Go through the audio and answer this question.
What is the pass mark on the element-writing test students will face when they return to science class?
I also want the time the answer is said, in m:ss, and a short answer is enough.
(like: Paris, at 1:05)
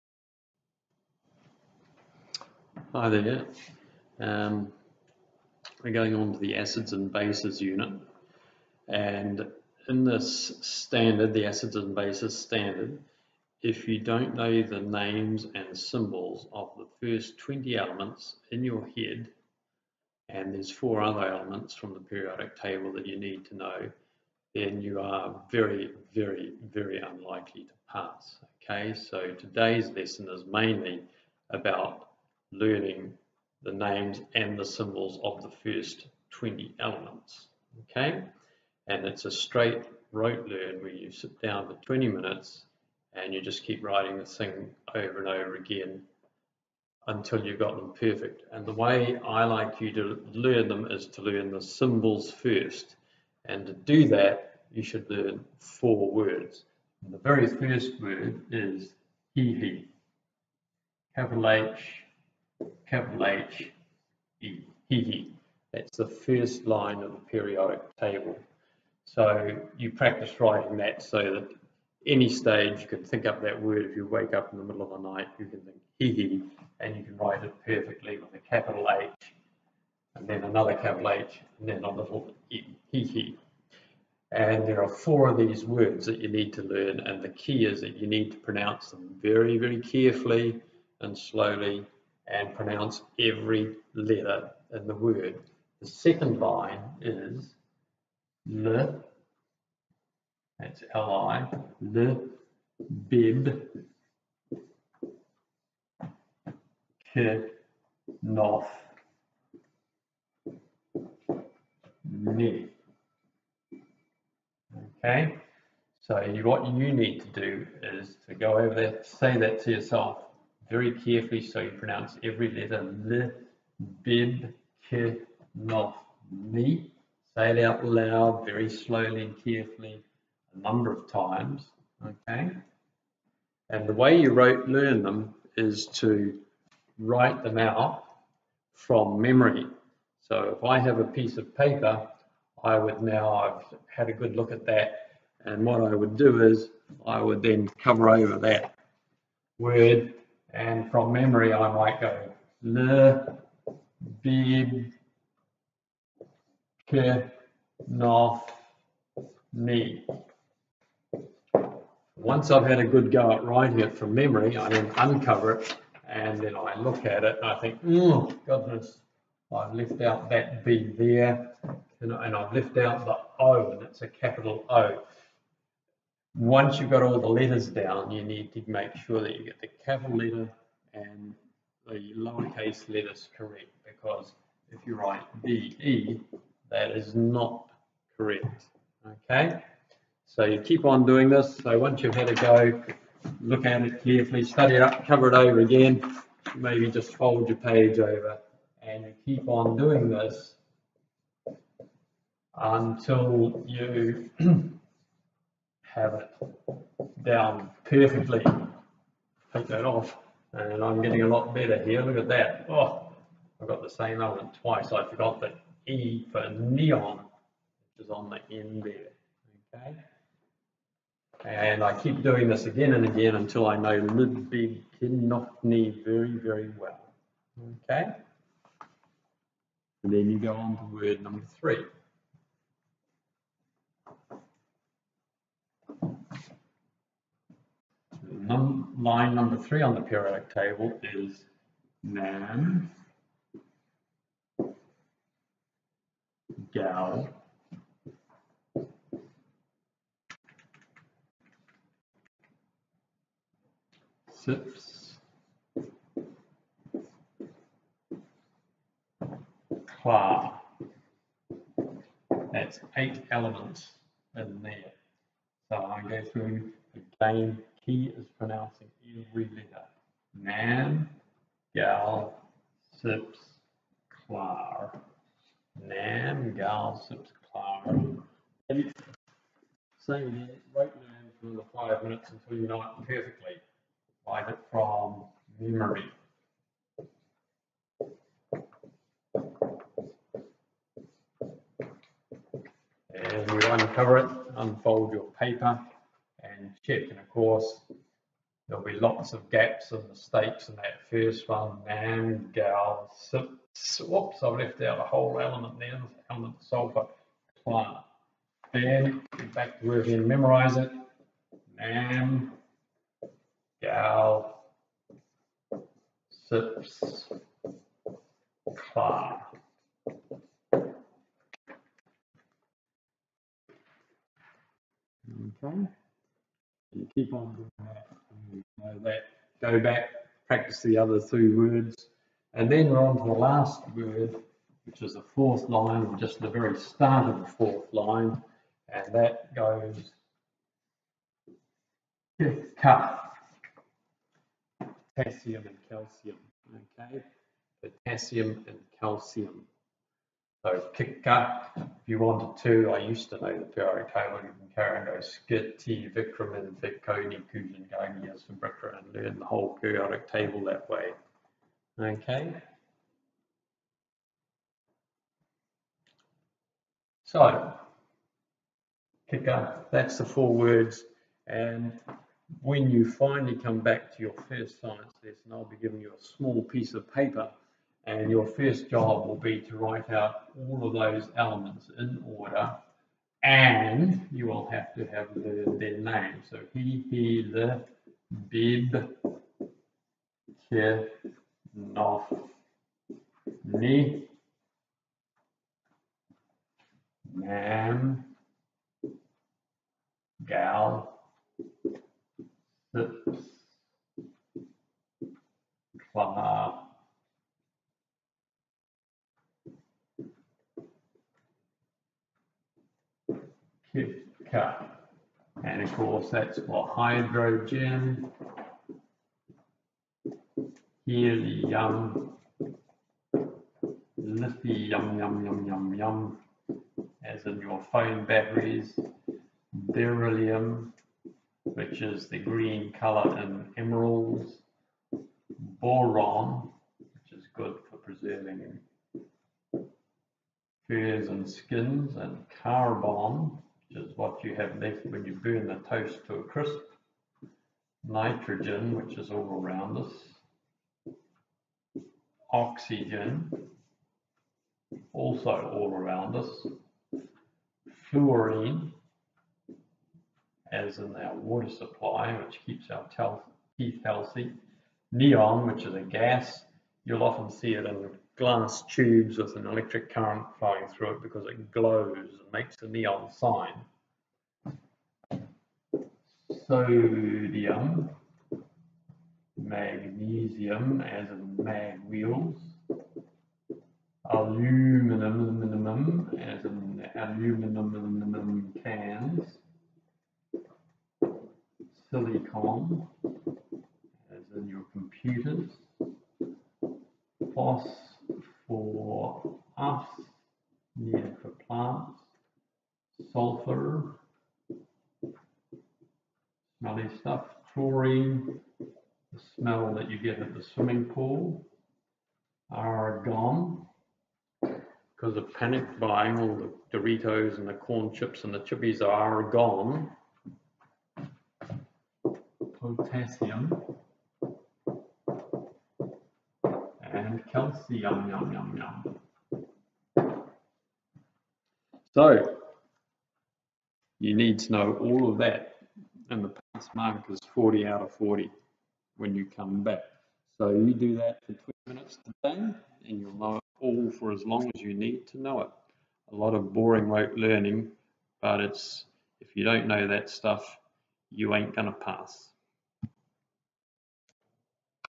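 40 out of 40, at 8:57.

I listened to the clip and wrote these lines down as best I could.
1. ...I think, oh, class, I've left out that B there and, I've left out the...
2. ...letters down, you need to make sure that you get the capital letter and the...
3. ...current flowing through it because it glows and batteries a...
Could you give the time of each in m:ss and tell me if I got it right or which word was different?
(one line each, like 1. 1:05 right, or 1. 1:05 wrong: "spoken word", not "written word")
1. 2:47 wrong: "goodness", not "class"
2. 2:57 right
3. 7:50 wrong: "makes", not "batteries".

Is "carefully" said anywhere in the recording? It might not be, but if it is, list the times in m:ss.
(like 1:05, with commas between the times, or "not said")
1:29, 2:00, 2:09, 3:14.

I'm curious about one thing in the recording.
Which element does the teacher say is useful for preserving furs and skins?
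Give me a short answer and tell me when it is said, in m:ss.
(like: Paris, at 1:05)
boron, at 7:15.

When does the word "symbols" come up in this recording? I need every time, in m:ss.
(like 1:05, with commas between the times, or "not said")
0:15, 0:34, 0:51.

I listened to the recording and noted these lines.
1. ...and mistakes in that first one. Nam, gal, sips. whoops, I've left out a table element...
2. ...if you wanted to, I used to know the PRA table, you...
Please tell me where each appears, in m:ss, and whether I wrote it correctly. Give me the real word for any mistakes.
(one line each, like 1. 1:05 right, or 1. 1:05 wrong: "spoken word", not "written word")
1. 4:59 wrong: "whole", not "table"
2. 5:51 right.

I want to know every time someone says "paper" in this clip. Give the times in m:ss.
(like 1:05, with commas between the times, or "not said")
2:21, 4:55, 6:17.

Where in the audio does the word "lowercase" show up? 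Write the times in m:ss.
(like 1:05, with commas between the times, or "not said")
3:02.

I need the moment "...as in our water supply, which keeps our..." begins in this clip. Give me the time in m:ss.
7:40.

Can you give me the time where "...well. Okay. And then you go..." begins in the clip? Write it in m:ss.
3:46.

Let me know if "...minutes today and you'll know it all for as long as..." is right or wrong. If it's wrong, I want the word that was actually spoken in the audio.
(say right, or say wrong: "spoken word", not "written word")
right.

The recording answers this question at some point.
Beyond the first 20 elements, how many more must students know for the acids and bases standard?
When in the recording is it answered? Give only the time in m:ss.
0:20.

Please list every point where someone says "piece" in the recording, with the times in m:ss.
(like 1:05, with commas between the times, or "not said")
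2:21, 6:16.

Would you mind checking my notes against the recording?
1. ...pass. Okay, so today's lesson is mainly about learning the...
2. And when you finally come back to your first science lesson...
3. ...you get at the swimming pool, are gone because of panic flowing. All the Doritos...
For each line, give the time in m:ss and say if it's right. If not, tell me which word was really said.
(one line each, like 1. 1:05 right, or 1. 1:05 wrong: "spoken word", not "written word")
1. 0:27 right
2. 6:11 right
3. 8:30 wrong: "buying", not "flowing".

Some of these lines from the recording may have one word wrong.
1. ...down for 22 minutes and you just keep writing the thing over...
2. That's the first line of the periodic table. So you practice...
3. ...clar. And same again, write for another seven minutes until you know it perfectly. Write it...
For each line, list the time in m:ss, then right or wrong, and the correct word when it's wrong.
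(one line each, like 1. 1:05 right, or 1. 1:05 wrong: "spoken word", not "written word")
1. 0:41 wrong: "20", not "22"
2. 1:05 right
3. 4:37 wrong: "five", not "seven".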